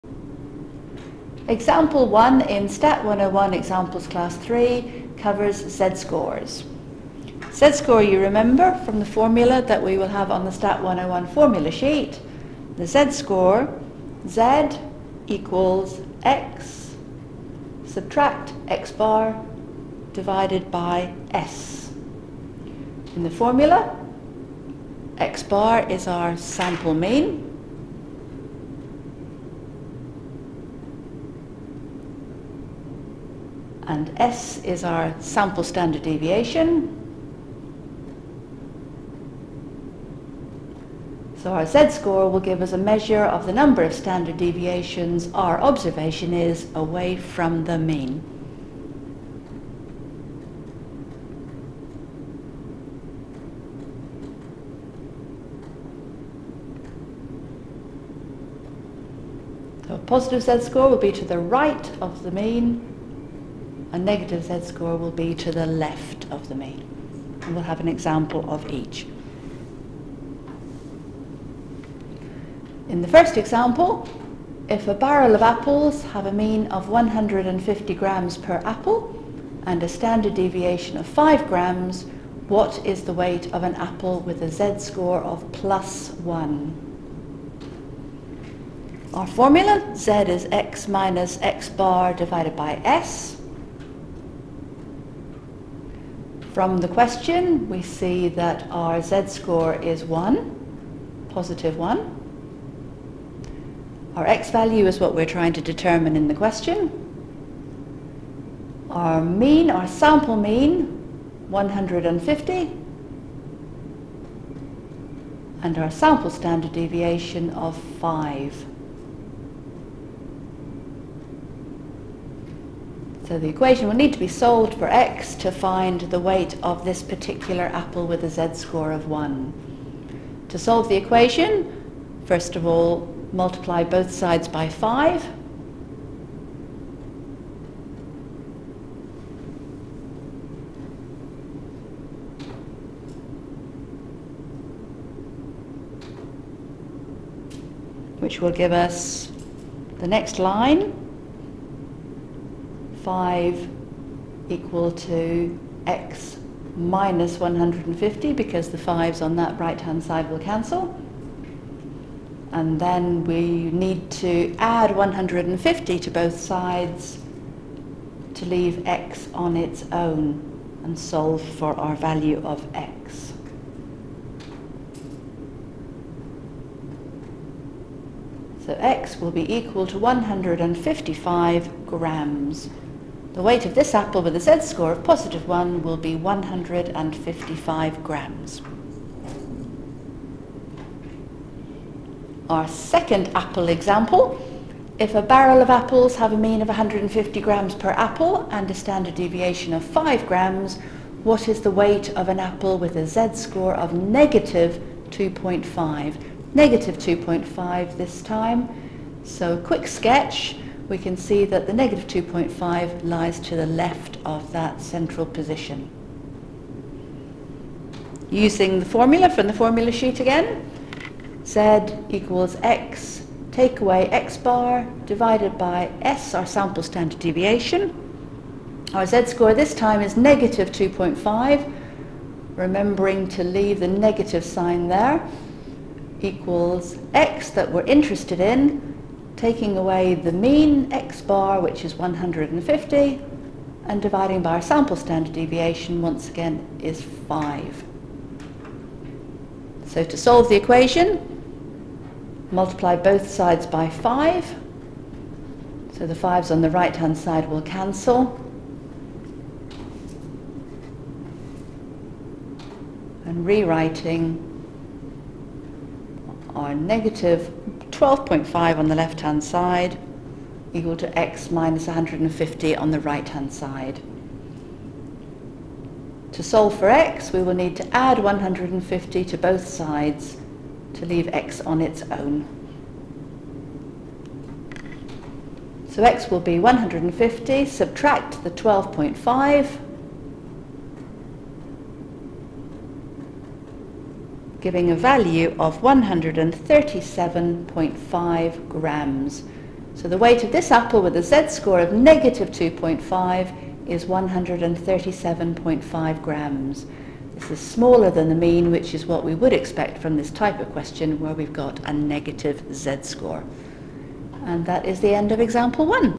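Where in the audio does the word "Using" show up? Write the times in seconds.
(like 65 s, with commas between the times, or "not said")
218 s.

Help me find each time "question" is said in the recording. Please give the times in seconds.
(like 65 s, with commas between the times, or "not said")
96 s, 106 s, 310 s.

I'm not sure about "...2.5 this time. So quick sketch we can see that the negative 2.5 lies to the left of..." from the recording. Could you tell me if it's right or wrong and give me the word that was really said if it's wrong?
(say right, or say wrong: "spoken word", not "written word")
right.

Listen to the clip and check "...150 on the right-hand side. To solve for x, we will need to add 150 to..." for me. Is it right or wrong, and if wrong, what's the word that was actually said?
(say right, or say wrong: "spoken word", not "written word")
right.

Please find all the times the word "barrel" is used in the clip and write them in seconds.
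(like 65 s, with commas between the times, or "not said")
74 s, 195 s.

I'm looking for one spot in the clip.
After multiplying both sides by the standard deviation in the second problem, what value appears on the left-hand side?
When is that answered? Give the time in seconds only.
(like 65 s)
266 s.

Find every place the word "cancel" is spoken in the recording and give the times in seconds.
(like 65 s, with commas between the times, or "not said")
160 s, 257 s.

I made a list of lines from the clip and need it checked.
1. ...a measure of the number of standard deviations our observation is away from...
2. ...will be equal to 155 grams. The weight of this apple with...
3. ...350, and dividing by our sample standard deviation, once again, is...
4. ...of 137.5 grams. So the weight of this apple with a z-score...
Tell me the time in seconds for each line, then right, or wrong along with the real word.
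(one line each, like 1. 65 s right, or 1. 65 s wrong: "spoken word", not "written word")
1. 42 s right
2. 179 s right
3. 241 s wrong: "150", not "350"
4. 295 s right.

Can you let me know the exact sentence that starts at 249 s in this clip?
So to solve the equation, multiply both sides by 5.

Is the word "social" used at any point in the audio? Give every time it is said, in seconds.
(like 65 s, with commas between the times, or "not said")
not said.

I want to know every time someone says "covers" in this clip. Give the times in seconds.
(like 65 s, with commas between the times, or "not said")
5 s.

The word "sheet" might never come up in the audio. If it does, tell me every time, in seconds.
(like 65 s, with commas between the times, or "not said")
11 s, 219 s.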